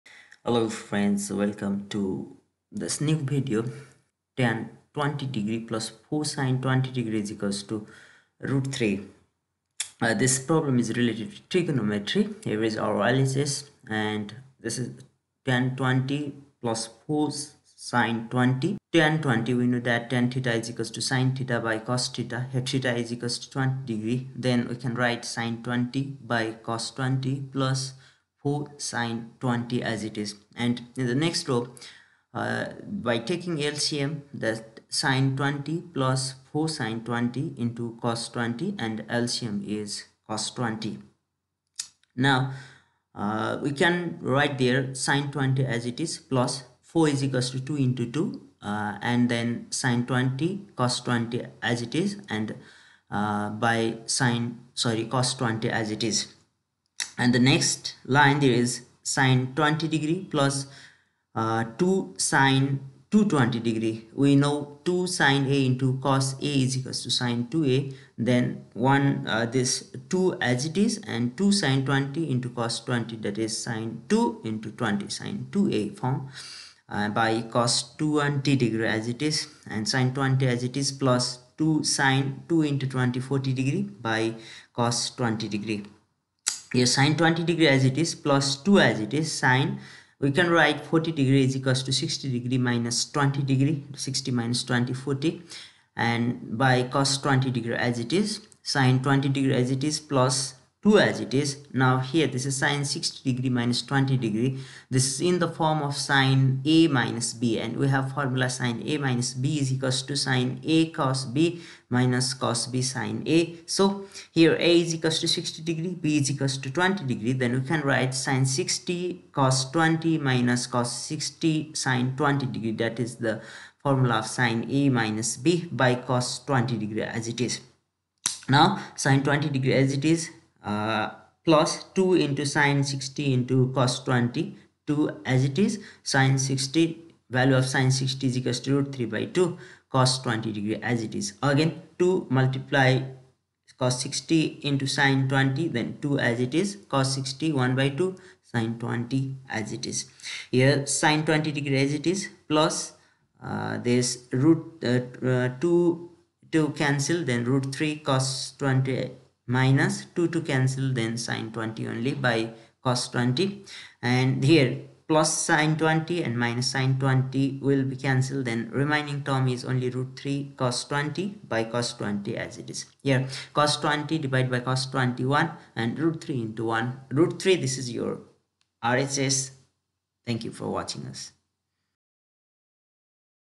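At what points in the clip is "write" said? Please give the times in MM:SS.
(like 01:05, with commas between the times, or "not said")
00:25, 00:44, 01:30, 01:57.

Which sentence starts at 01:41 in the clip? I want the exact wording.
Now here this is sine 60 degree minus 20 degree.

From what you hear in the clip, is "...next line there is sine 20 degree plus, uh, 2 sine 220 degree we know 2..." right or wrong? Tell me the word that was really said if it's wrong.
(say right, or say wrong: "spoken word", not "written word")
right.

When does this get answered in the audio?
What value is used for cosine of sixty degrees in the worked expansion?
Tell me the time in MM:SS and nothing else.
02:27.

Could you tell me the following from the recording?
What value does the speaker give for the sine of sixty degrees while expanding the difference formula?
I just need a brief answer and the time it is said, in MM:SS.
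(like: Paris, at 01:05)
root 3 by 2, at 02:18.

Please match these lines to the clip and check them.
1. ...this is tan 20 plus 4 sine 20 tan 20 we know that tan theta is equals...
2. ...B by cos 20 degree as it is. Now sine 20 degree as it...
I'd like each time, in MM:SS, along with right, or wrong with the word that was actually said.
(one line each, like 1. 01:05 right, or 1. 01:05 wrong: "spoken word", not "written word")
1. 00:14 right
2. 02:05 right.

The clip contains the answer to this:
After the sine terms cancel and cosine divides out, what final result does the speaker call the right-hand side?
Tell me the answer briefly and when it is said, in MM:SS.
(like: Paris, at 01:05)
root 3, at 02:57.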